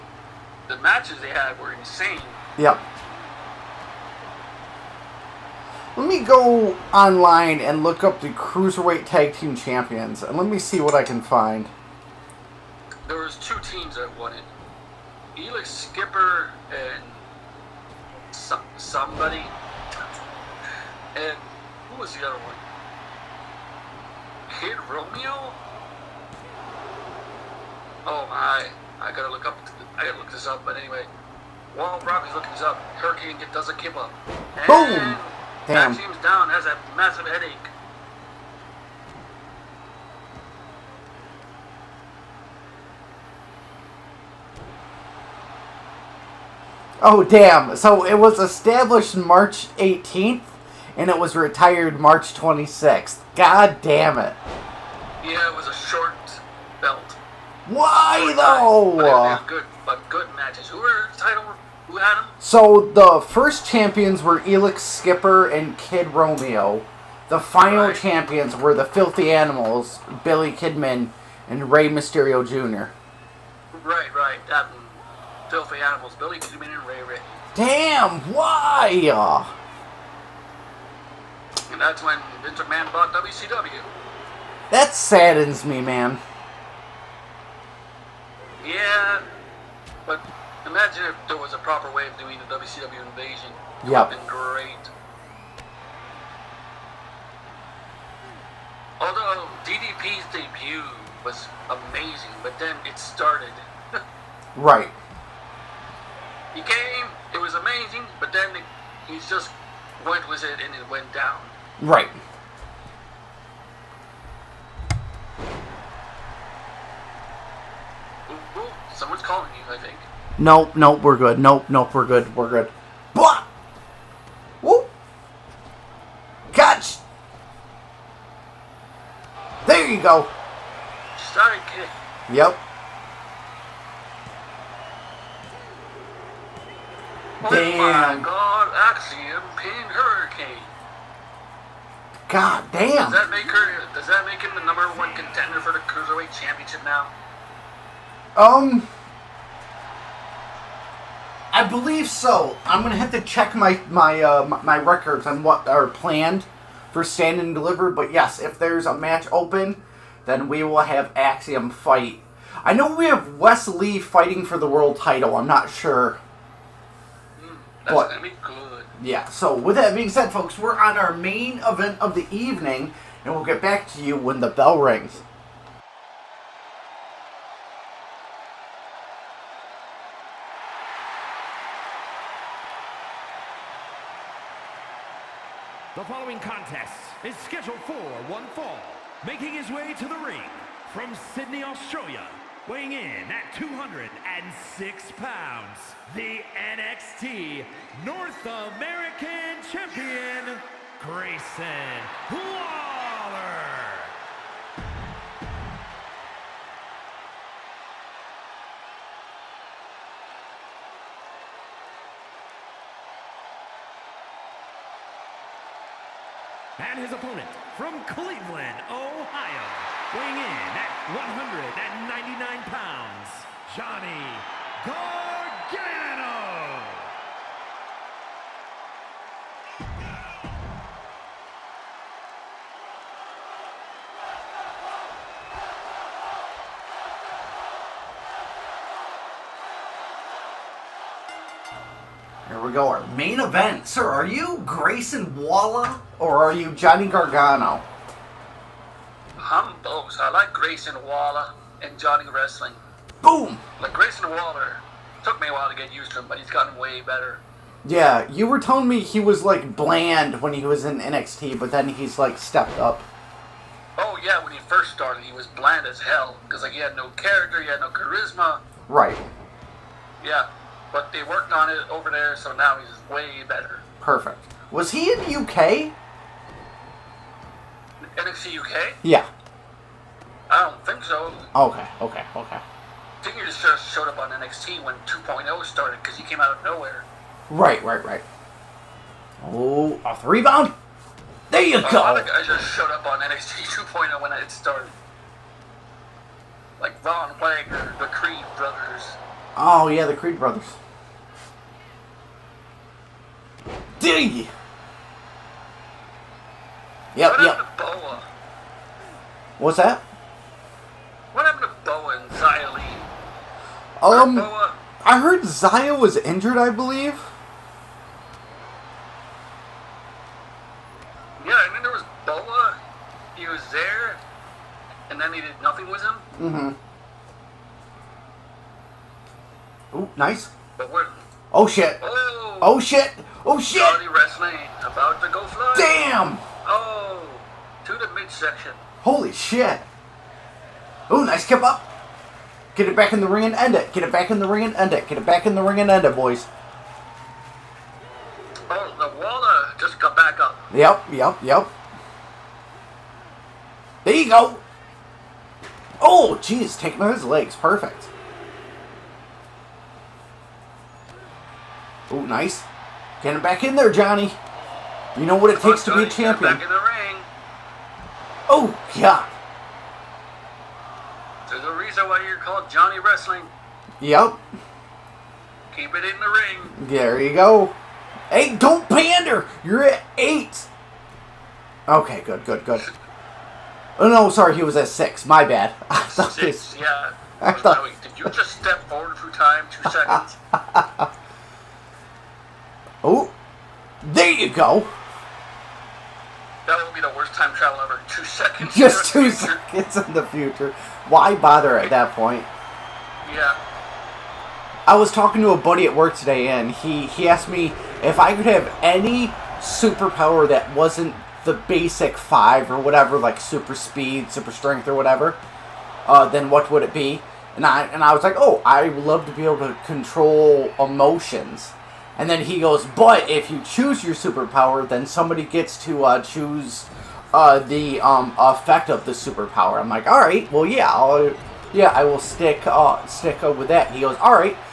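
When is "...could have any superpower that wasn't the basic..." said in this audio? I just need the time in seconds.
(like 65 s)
408 s.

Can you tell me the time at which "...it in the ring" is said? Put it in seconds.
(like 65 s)
375 s.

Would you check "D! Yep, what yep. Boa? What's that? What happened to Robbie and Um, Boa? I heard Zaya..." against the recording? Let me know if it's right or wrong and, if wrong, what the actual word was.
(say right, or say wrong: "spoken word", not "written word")
wrong: "Boa", not "Robbie".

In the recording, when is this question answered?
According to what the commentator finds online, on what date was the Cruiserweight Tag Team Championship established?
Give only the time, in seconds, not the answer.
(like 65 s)
49 s.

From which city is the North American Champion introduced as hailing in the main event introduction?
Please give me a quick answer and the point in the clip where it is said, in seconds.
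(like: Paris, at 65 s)
Sydney, Australia, at 191 s.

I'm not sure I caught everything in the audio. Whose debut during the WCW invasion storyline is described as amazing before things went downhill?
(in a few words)
DDP.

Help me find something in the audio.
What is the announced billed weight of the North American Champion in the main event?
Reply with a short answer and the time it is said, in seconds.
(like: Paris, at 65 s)
206 pounds, at 193 s.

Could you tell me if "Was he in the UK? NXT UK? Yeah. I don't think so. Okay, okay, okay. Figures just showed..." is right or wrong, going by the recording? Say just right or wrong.
right.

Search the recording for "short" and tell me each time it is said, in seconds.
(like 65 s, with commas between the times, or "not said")
55 s.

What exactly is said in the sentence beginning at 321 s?
Yeah, and then there was Boa.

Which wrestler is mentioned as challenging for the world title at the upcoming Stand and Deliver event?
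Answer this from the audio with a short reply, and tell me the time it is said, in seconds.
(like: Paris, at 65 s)
Wes Lee, at 163 s.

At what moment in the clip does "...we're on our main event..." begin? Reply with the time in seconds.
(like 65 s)
170 s.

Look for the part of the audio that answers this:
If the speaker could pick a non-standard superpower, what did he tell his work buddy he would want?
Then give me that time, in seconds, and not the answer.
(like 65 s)
419 s.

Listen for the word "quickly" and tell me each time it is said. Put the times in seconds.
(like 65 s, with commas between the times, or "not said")
not said.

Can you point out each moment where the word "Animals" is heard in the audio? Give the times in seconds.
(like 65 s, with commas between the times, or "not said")
69 s, 75 s.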